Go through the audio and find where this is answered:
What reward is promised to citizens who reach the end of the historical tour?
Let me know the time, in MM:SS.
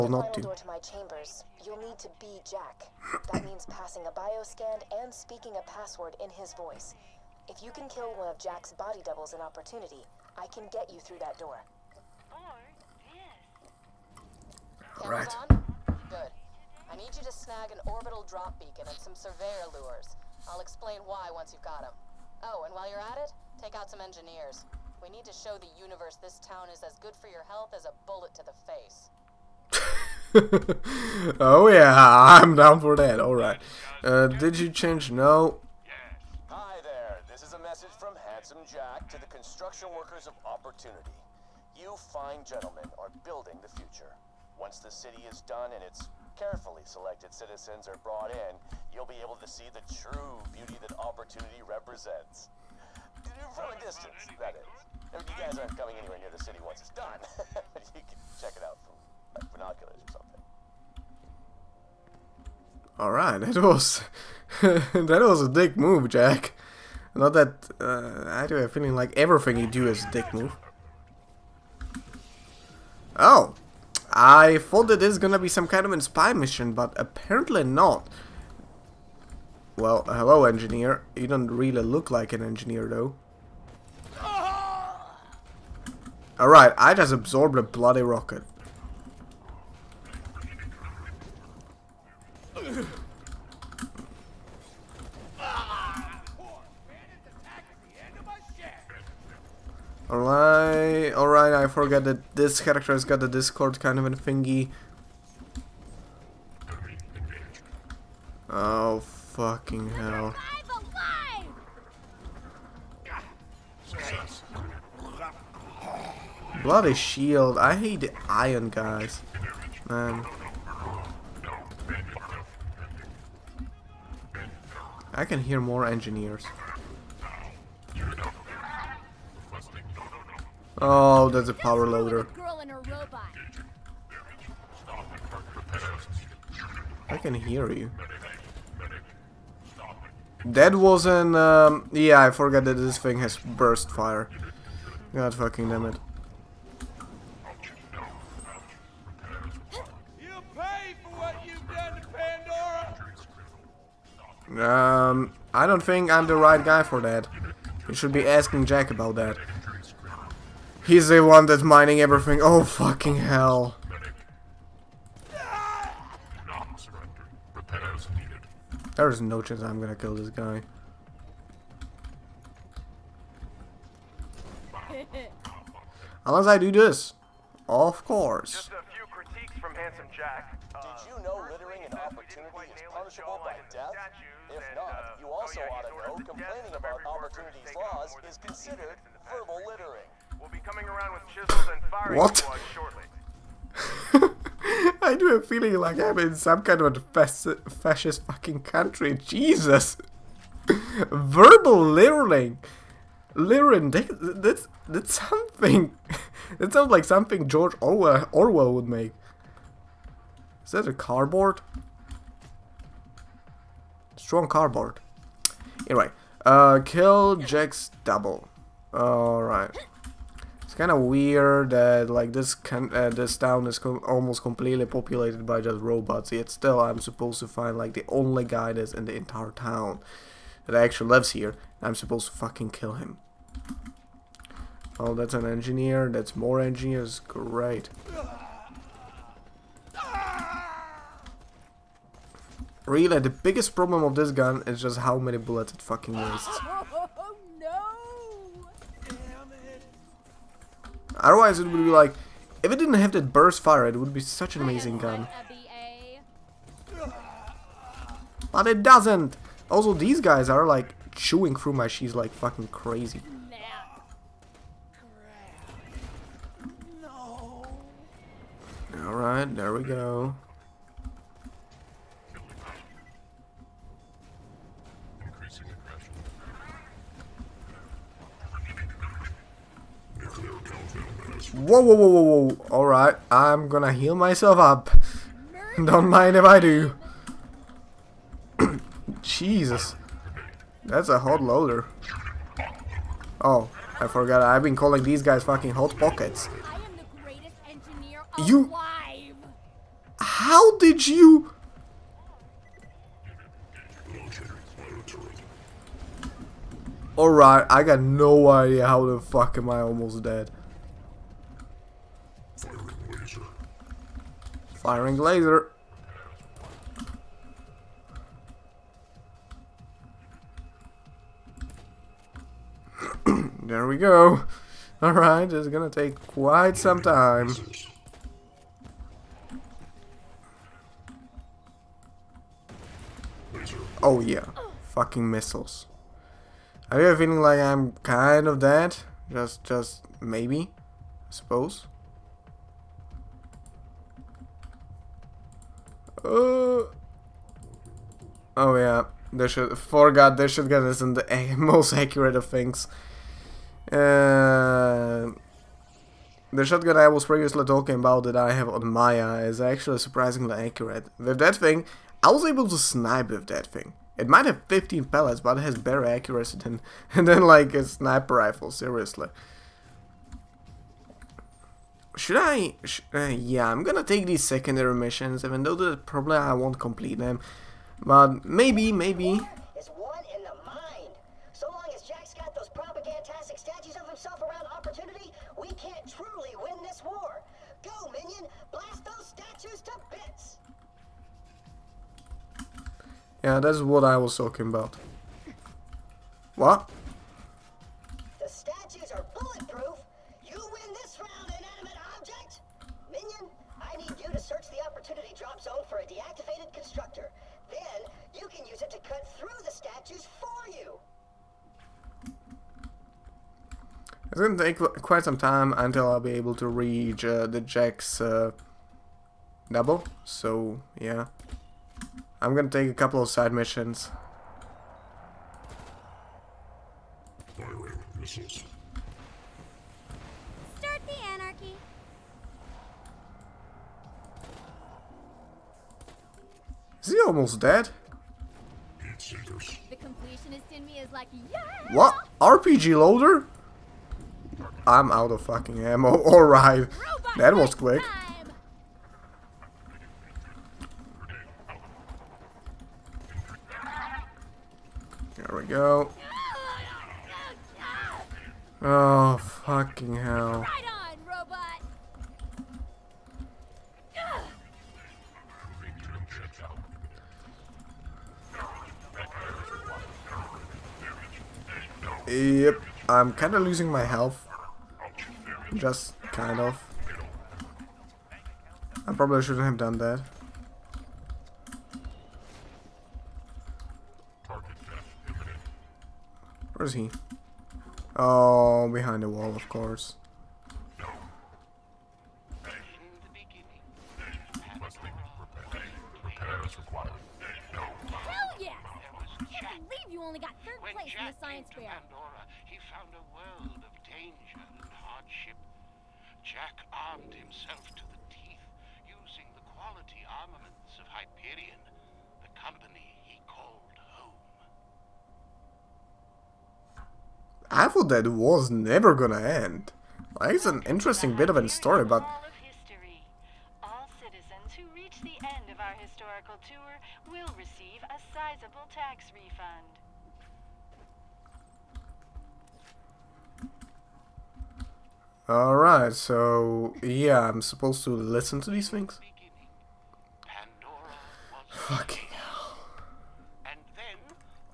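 08:48.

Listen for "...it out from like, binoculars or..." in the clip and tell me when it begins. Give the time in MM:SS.
00:58.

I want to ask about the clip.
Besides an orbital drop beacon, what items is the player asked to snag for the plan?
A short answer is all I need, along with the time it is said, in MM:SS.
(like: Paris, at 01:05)
surveyor lures, at 00:19.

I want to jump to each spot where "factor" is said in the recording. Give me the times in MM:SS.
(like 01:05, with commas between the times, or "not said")
not said.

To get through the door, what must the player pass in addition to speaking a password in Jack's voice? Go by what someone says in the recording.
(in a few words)
bioscan.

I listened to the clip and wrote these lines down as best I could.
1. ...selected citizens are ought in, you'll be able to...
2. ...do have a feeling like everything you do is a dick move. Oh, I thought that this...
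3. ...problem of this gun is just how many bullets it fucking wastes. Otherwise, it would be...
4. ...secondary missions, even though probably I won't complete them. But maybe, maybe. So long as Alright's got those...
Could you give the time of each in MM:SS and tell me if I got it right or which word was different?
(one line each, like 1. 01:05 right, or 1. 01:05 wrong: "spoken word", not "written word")
1. 00:46 wrong: "brought", not "ought"
2. 01:08 right
3. 04:03 right
4. 06:14 wrong: "Jack", not "Alright".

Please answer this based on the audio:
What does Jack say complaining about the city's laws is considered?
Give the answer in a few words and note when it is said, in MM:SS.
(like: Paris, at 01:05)
verbal littering, at 03:09.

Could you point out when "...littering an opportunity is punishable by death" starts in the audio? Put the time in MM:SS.
03:01.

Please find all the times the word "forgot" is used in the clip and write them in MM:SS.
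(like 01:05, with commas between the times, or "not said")
02:22, 04:54.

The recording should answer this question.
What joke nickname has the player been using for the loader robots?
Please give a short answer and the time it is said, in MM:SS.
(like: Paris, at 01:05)
hot pockets, at 04:55.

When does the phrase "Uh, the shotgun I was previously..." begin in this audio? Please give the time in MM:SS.
05:53.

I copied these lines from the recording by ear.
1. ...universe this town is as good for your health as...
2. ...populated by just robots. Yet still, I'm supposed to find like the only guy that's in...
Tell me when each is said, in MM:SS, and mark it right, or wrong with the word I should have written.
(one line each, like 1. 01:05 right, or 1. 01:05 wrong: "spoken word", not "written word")
1. 00:25 right
2. 03:44 right.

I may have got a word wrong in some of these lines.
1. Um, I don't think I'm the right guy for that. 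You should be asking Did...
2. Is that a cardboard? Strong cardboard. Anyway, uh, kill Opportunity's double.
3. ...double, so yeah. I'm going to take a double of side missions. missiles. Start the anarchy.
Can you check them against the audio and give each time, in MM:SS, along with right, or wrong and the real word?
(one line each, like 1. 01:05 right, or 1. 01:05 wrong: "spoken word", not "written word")
1. 02:34 wrong: "Jack", not "Did"
2. 03:30 wrong: "Jack", not "Opportunity"
3. 06:59 wrong: "couple", not "double".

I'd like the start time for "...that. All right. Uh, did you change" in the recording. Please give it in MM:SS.
00:32.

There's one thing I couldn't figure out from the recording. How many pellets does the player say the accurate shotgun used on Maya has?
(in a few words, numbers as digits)
15.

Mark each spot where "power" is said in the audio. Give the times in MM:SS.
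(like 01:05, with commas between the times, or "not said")
02:11.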